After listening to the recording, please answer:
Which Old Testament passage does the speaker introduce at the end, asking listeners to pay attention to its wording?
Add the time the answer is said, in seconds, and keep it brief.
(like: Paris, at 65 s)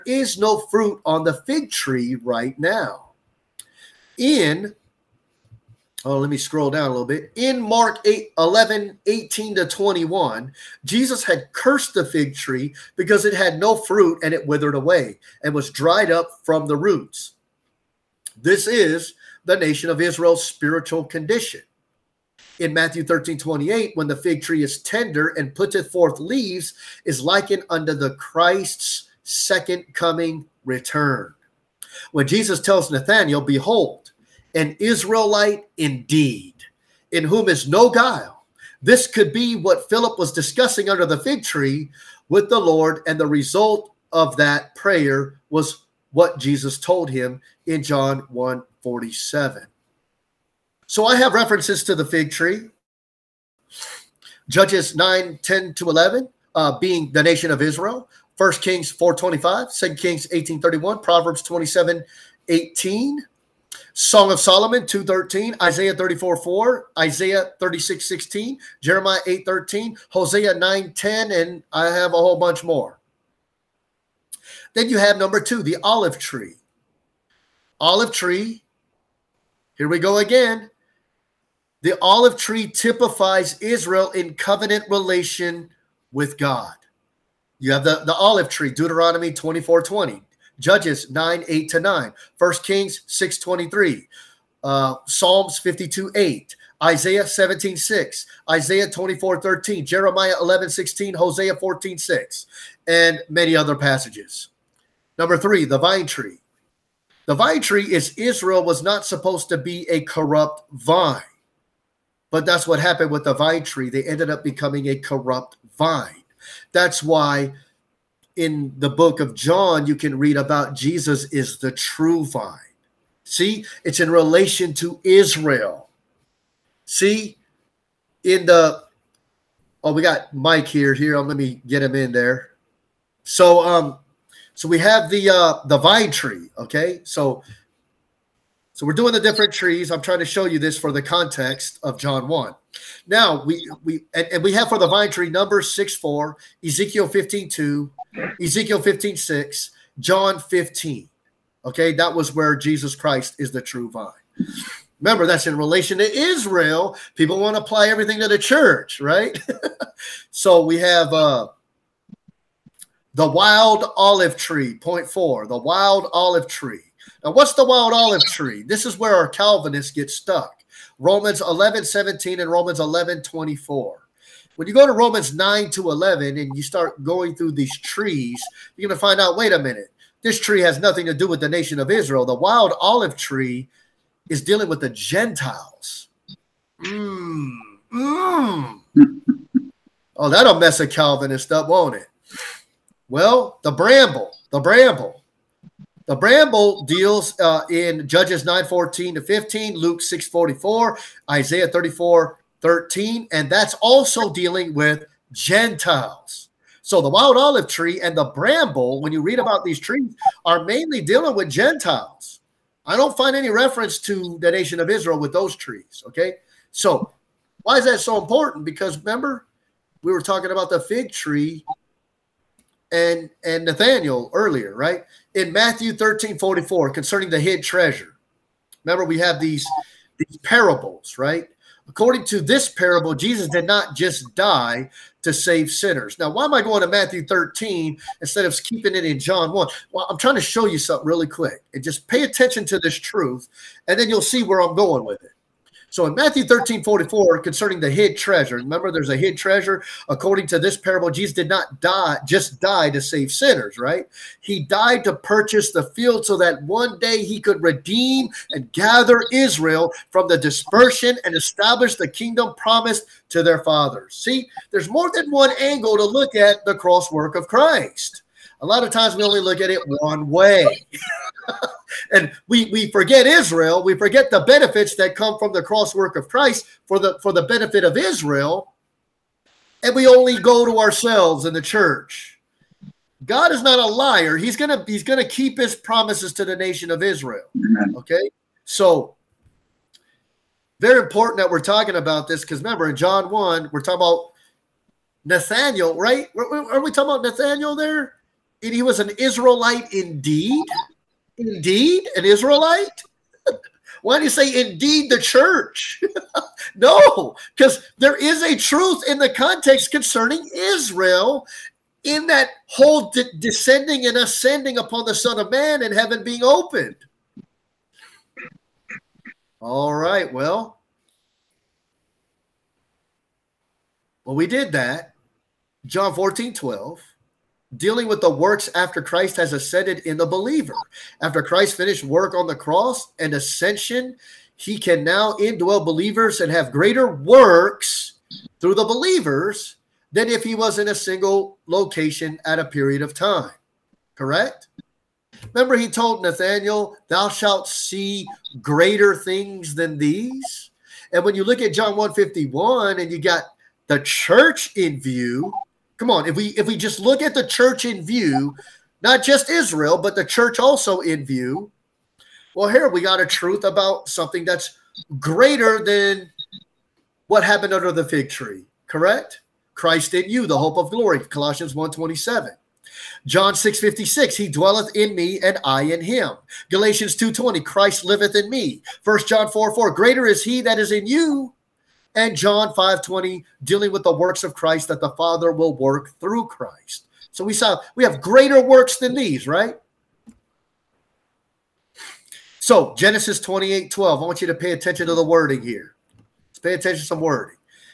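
Genesis 28:12, at 392 s.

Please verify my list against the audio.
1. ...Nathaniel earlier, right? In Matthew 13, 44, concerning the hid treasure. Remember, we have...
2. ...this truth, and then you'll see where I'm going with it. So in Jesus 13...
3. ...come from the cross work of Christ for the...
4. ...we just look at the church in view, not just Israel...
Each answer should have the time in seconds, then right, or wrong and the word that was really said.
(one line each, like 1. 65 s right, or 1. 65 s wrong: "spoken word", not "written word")
1. 223 s right
2. 242 s wrong: "Matthew", not "Jesus"
3. 275 s right
4. 356 s right.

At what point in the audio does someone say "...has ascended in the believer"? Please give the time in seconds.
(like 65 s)
329 s.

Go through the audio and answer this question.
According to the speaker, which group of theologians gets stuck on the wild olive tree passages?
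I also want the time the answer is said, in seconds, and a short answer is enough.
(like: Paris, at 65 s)
Calvinists, at 169 s.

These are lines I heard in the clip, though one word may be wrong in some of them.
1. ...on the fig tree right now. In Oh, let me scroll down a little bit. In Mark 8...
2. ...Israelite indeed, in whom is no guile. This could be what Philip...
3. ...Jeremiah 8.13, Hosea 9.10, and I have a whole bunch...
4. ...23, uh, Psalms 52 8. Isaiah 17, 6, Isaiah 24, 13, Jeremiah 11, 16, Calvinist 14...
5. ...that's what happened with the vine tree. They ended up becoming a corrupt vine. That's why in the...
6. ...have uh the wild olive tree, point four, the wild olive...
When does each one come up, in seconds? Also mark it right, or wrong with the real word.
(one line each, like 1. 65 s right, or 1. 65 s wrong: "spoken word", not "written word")
1. 1 s right
2. 34 s right
3. 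68 s right
4. 93 s wrong: "Hosea", not "Calvinist"
5. 112 s right
6. 160 s right.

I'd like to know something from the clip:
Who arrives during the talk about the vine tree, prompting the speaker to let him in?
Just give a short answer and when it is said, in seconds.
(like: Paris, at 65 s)
Mike, at 130 s.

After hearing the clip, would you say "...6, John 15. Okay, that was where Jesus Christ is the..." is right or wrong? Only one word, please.
right.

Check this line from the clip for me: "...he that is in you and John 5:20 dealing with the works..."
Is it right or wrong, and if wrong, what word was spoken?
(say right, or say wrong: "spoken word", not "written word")
right.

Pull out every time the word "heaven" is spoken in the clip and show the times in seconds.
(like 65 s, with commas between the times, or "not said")
315 s.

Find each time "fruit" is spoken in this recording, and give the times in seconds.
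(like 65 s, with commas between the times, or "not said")
0 s, 13 s.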